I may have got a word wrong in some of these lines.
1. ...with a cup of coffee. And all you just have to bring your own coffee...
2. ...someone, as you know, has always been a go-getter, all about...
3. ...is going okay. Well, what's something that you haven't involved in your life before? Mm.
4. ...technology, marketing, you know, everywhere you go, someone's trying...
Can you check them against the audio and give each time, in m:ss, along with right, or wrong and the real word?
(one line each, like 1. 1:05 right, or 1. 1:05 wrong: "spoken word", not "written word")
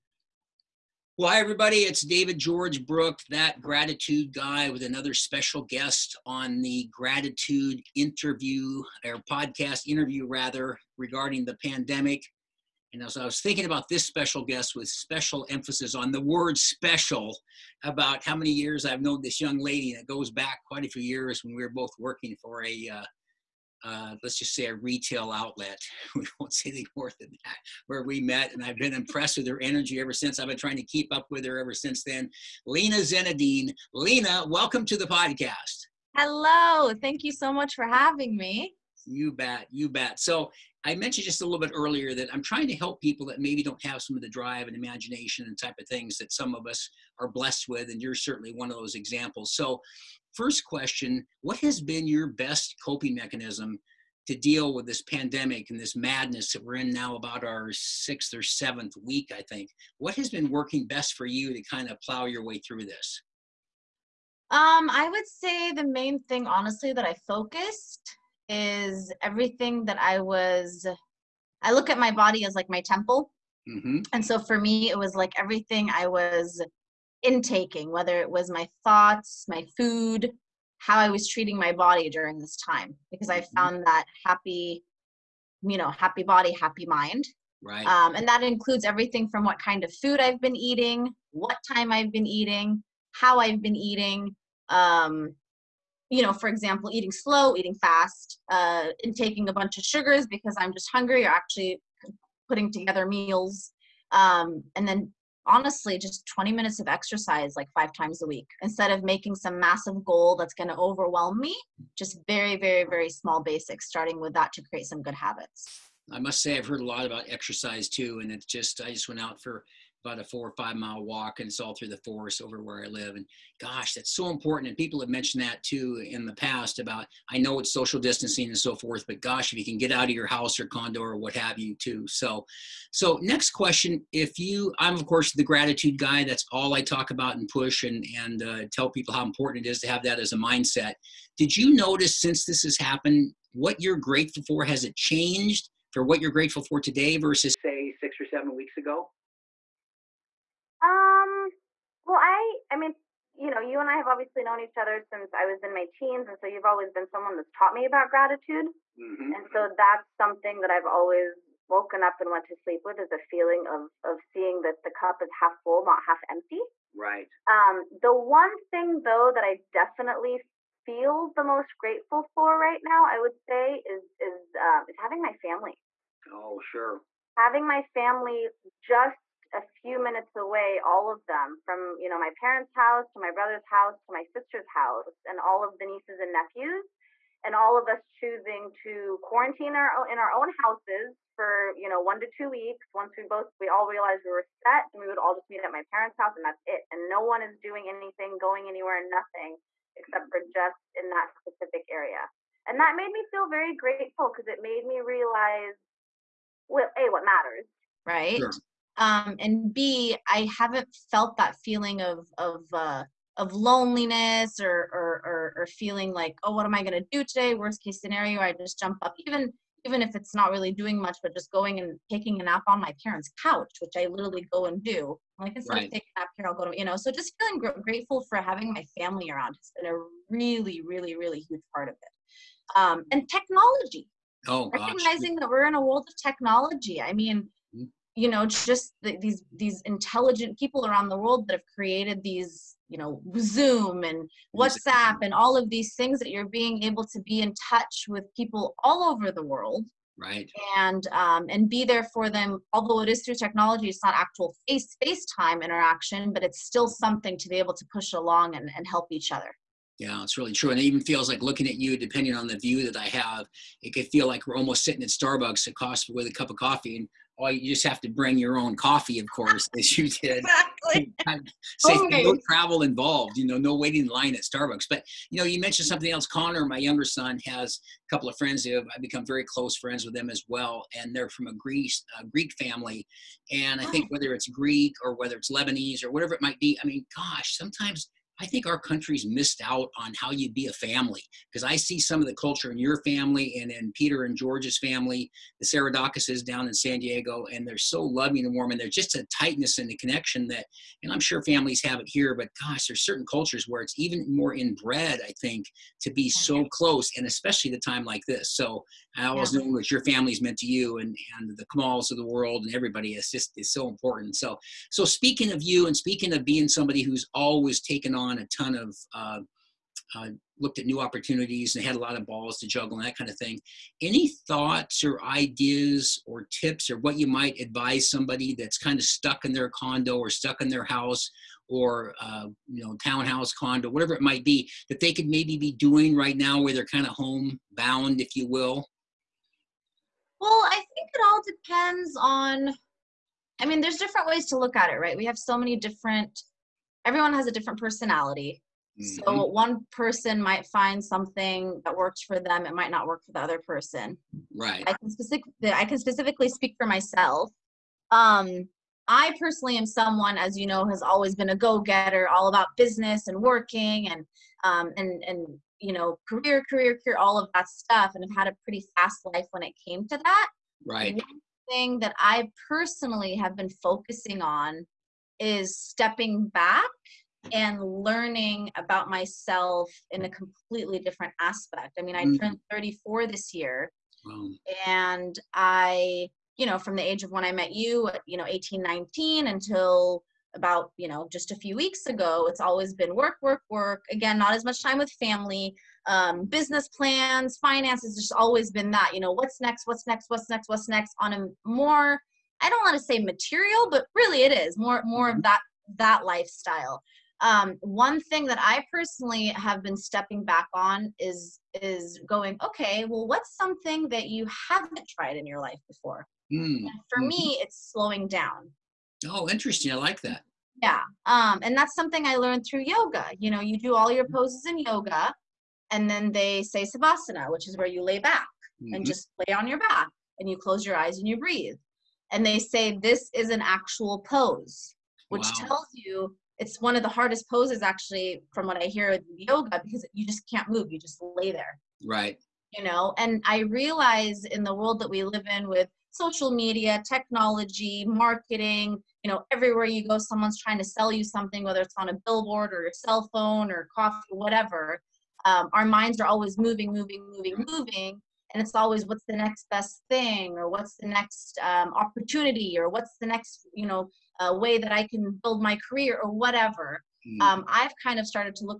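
1. 4:26 right
2. 5:59 right
3. 6:51 wrong: "tried", not "involved"
4. 7:27 right.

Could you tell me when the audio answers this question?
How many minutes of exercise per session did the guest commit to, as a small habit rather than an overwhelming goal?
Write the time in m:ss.
1:46.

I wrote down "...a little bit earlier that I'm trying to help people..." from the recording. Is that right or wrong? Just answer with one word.
right.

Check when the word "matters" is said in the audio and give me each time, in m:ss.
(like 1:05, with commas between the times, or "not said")
3:27.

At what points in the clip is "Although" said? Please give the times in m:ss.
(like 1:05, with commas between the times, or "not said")
4:12.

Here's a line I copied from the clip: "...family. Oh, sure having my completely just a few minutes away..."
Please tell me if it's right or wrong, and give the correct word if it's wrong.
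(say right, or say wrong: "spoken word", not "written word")
wrong: "family", not "completely".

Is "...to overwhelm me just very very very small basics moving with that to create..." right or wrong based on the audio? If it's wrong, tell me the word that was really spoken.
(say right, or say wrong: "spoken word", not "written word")
wrong: "starting", not "moving".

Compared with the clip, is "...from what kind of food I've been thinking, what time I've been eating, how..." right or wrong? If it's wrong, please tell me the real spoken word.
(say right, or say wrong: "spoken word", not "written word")
wrong: "eating", not "thinking".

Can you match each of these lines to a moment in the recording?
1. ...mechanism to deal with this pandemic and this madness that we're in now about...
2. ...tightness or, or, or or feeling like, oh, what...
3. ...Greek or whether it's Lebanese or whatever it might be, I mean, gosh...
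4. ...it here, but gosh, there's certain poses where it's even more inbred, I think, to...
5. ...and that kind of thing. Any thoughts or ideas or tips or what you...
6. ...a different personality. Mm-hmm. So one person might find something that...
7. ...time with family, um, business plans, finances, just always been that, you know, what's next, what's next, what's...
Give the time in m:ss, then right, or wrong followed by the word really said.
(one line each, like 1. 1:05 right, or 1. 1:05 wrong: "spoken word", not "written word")
1. 0:53 right
2. 3:33 wrong: "loneliness", not "tightness"
3. 4:44 right
4. 5:01 wrong: "cultures", not "poses"
5. 5:22 right
6. 5:47 right
7. 6:34 right.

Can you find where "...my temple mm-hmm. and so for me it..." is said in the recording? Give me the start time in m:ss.
1:12.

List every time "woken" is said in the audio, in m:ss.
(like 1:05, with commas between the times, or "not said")
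2:41.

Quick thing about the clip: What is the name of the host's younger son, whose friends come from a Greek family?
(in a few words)
Connor.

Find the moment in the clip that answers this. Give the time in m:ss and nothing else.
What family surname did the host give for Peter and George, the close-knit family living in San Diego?
4:55.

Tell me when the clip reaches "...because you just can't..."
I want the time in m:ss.
7:19.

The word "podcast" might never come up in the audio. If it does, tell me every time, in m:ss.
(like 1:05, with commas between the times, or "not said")
0:09, 0:35.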